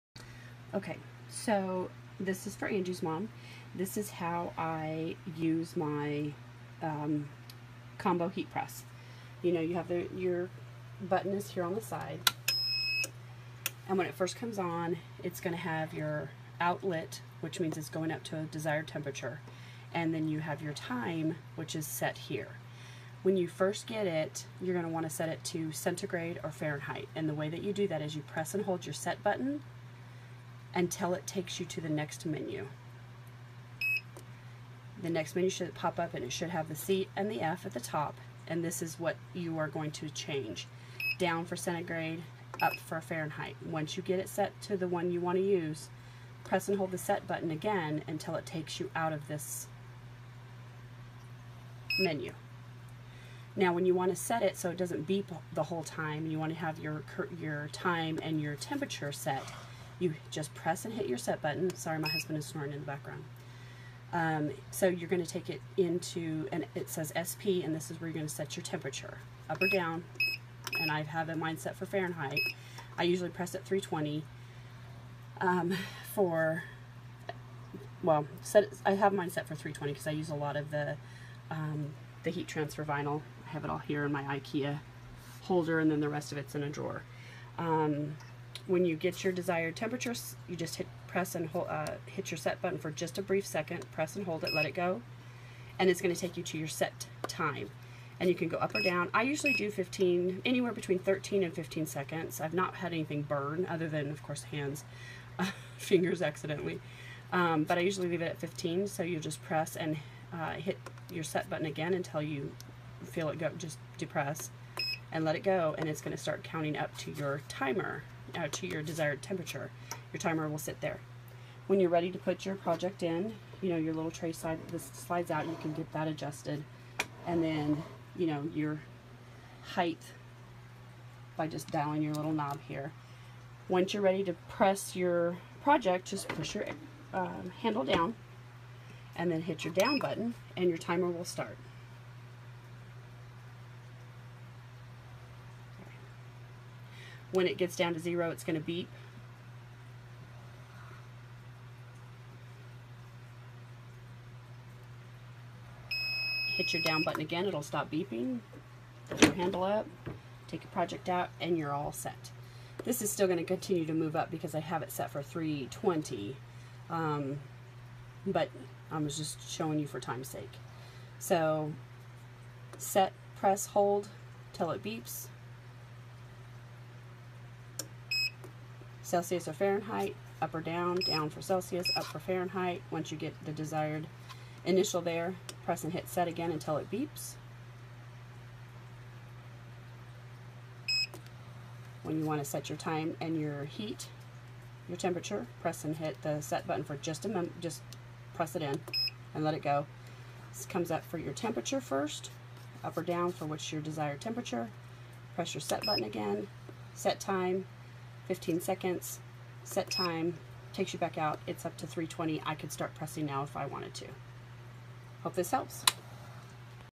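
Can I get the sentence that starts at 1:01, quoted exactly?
Sorry, my husband is snoring in the background.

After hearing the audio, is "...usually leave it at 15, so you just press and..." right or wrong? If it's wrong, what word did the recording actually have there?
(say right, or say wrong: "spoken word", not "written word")
right.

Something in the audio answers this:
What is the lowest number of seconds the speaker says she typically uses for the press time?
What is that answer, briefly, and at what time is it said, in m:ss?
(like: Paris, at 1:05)
13, at 1:40.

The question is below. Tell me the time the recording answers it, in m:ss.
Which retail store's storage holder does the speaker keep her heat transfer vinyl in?
1:24.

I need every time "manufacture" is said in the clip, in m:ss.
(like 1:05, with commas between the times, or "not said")
not said.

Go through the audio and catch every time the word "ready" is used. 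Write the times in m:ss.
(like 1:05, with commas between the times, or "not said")
2:01, 2:14.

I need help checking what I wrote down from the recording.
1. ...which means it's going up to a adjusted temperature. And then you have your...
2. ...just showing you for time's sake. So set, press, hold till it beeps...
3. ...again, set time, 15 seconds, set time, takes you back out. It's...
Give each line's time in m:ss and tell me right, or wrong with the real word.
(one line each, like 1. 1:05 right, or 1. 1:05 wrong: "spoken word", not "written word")
1. 0:17 wrong: "desired", not "adjusted"
2. 2:49 right
3. 3:26 right.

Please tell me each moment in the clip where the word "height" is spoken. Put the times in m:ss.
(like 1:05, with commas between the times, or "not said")
2:09.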